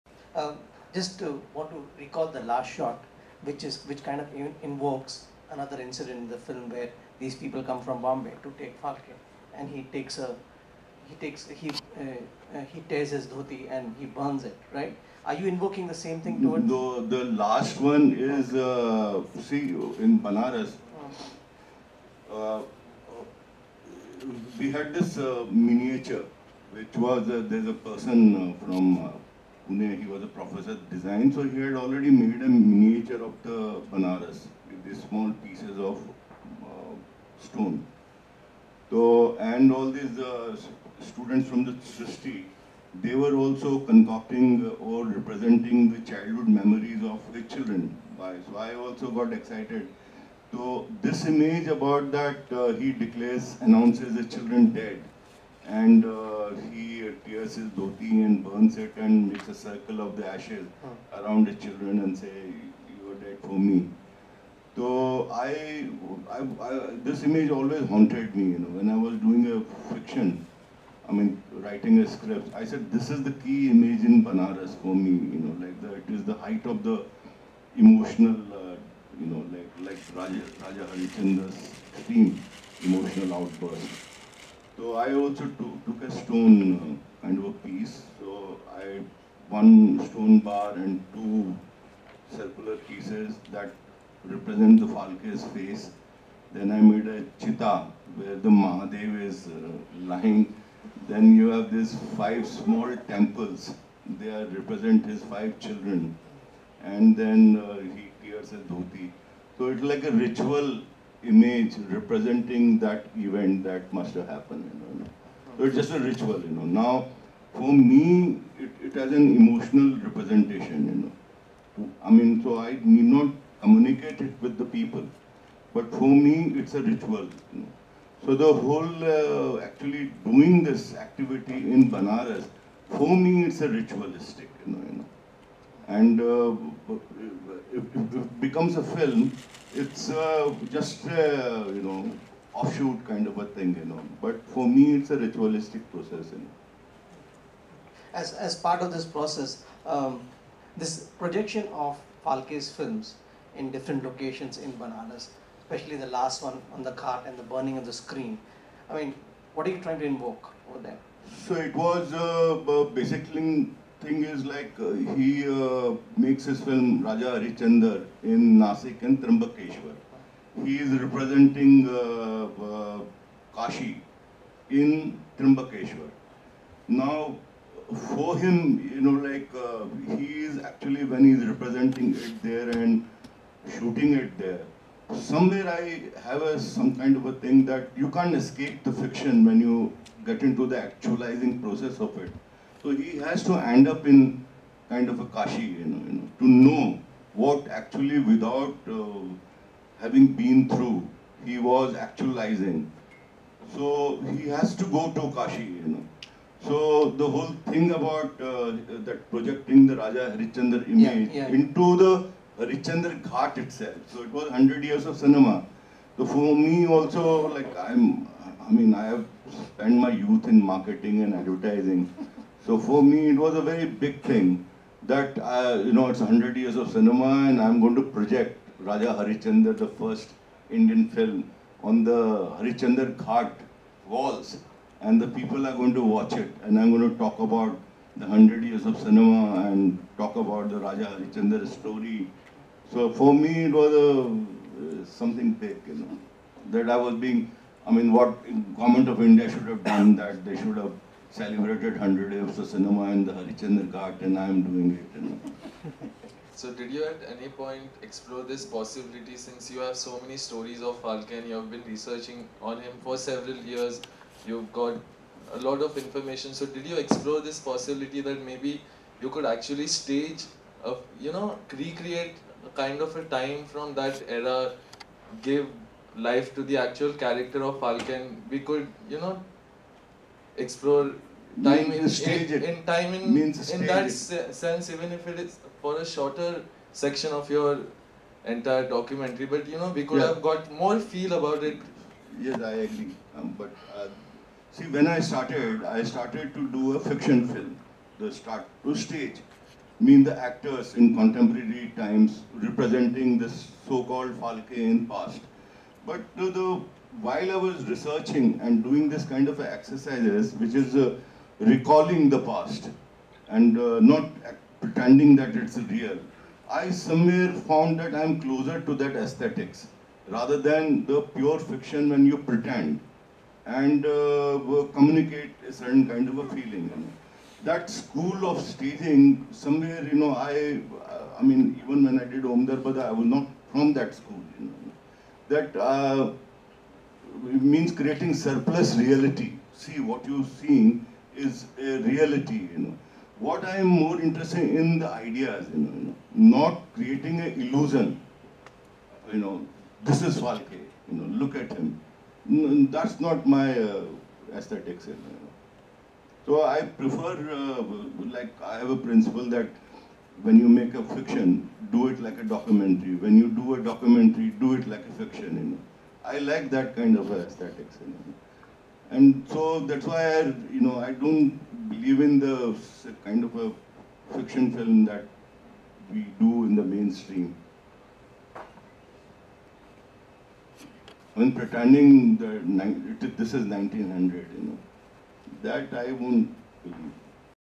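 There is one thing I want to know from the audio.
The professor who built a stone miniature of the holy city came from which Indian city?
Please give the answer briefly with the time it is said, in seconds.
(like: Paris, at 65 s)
Pune, at 29 s.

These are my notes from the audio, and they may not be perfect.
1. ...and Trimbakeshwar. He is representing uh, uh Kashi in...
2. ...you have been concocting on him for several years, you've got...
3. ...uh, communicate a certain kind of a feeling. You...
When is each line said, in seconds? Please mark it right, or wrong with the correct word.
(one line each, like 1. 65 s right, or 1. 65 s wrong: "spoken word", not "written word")
1. 169 s right
2. 261 s wrong: "researching", not "concocting"
3. 324 s right.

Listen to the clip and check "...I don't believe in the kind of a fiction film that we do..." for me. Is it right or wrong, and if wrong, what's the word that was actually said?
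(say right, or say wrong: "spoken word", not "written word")
right.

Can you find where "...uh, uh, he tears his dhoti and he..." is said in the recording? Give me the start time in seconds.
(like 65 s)
11 s.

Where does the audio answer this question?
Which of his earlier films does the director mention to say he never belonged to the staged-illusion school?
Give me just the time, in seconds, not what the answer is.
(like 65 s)
332 s.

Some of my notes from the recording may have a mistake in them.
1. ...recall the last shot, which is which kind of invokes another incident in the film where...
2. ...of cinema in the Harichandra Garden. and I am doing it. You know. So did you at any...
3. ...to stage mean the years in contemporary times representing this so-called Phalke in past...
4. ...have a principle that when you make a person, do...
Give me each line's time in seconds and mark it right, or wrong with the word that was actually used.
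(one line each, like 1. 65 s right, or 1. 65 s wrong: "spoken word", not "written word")
1. 1 s right
2. 252 s right
3. 298 s wrong: "actors", not "years"
4. 358 s wrong: "fiction", not "person".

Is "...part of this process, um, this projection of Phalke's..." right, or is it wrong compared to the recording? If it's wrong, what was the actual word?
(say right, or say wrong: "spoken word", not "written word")
right.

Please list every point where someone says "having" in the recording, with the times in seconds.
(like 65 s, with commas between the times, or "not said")
199 s.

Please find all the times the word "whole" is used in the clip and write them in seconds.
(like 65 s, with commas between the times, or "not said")
128 s, 207 s.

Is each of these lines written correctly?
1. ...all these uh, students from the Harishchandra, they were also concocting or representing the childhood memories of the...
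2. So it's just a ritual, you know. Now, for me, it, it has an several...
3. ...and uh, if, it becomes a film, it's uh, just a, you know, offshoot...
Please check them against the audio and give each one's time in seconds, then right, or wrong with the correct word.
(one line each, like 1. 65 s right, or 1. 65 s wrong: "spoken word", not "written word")
1. 39 s wrong: "Srishti", not "Harishchandra"
2. 115 s wrong: "emotional", not "several"
3. 135 s right.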